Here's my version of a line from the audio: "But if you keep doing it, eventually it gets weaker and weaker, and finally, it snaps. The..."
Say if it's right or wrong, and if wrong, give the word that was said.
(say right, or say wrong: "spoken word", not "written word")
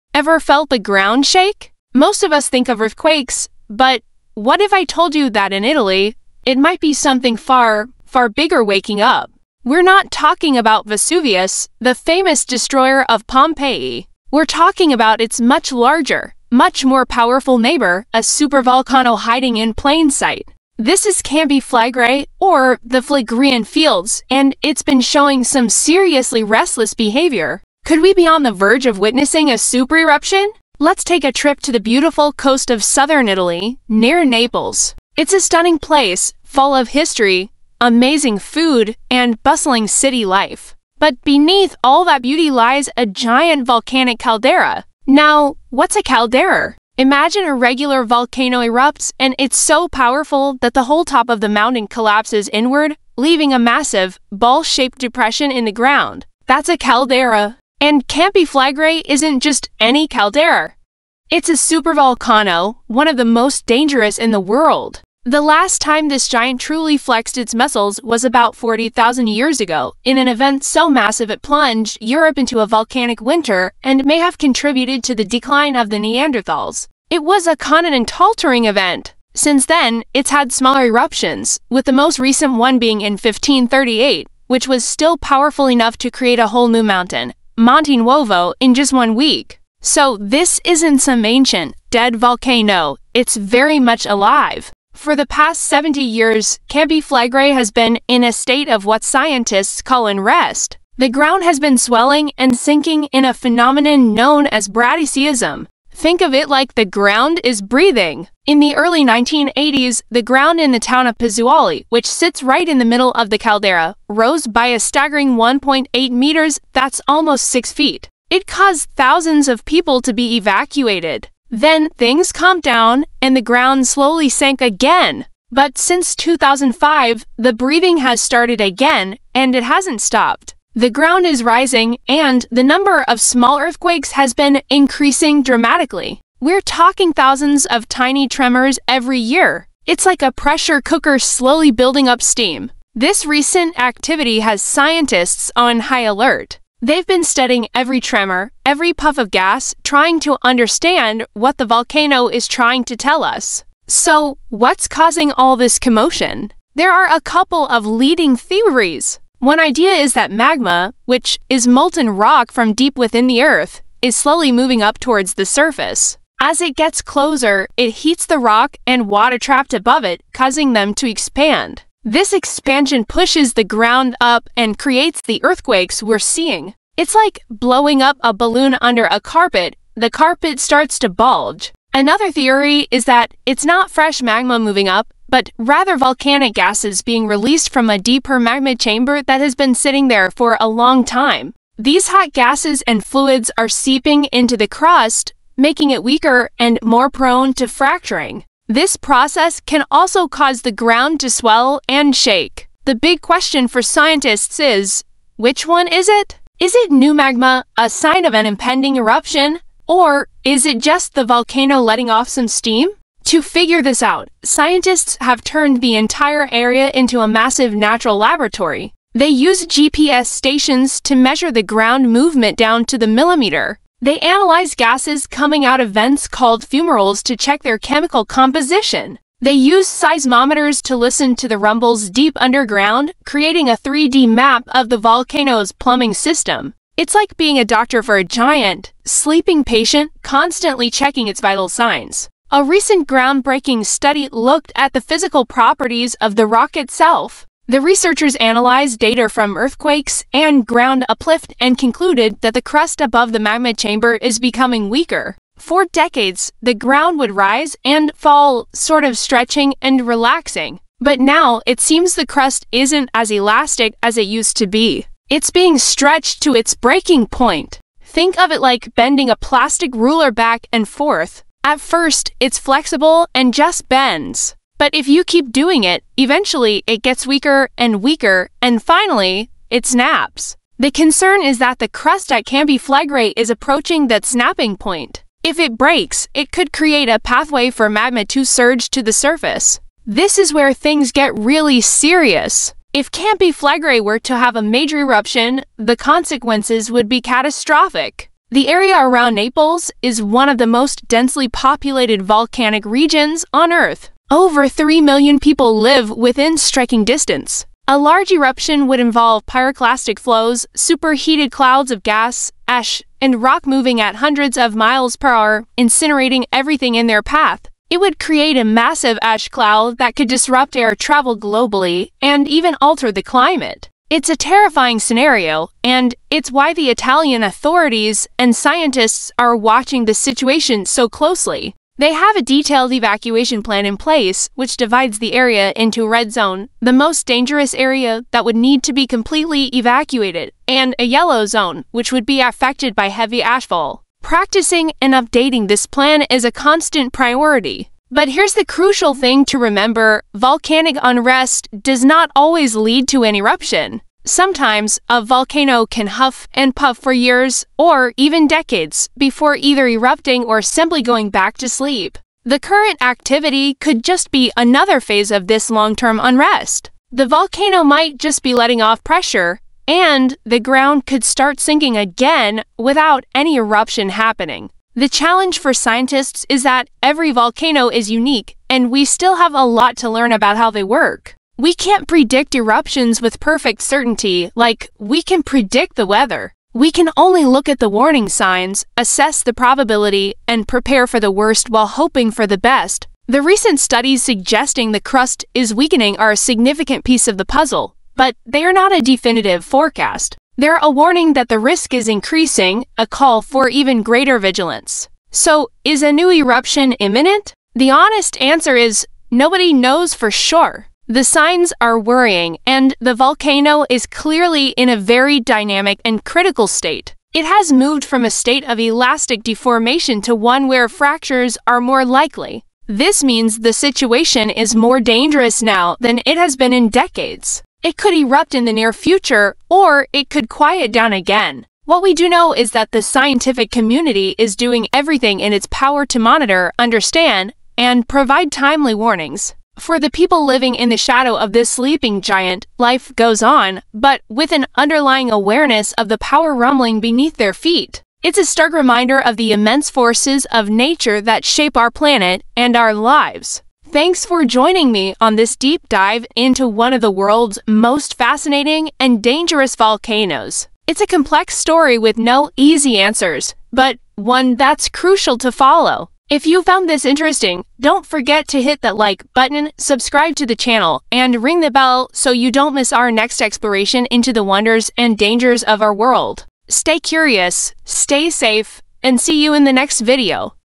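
right.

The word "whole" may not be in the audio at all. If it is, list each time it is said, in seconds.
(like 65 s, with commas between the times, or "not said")
50 s, 86 s.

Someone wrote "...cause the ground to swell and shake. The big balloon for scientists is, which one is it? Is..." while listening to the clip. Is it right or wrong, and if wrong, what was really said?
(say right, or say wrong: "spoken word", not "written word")
wrong: "question", not "balloon".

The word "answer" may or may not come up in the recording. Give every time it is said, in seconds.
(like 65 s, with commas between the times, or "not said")
408 s, 462 s.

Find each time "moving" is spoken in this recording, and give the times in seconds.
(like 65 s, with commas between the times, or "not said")
164 s, 184 s, 313 s.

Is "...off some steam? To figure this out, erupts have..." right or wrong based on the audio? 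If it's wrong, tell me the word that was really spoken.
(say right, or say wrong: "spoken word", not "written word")
wrong: "scientists", not "erupts".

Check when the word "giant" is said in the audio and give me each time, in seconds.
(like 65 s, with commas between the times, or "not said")
43 s, 66 s, 238 s, 442 s.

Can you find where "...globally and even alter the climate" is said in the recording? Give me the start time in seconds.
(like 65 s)
321 s.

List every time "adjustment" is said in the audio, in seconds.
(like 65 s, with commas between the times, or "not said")
not said.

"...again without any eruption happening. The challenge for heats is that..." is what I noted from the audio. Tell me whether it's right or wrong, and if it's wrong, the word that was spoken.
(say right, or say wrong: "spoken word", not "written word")
wrong: "scientists", not "heats".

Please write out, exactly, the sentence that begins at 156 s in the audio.
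There are a couple of leading theories.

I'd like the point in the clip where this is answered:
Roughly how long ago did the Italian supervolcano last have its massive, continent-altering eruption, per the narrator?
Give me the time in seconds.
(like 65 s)
68 s.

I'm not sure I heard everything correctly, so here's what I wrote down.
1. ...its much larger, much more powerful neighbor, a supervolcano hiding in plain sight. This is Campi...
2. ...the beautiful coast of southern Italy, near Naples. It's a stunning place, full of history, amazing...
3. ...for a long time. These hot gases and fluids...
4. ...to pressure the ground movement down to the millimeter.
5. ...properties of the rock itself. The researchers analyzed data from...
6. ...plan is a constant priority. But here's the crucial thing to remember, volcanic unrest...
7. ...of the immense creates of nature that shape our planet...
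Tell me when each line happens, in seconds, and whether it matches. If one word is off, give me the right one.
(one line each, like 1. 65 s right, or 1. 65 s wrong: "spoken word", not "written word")
1. 15 s right
2. 31 s right
3. 190 s right
4. 220 s wrong: "measure", not "pressure"
5. 245 s right
6. 345 s right
7. 449 s wrong: "forces", not "creates".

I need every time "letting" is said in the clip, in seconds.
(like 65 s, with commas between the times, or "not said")
211 s, 368 s.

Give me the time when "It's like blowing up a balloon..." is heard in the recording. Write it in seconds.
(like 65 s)
176 s.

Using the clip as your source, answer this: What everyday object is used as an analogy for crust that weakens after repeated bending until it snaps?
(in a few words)
plastic ruler.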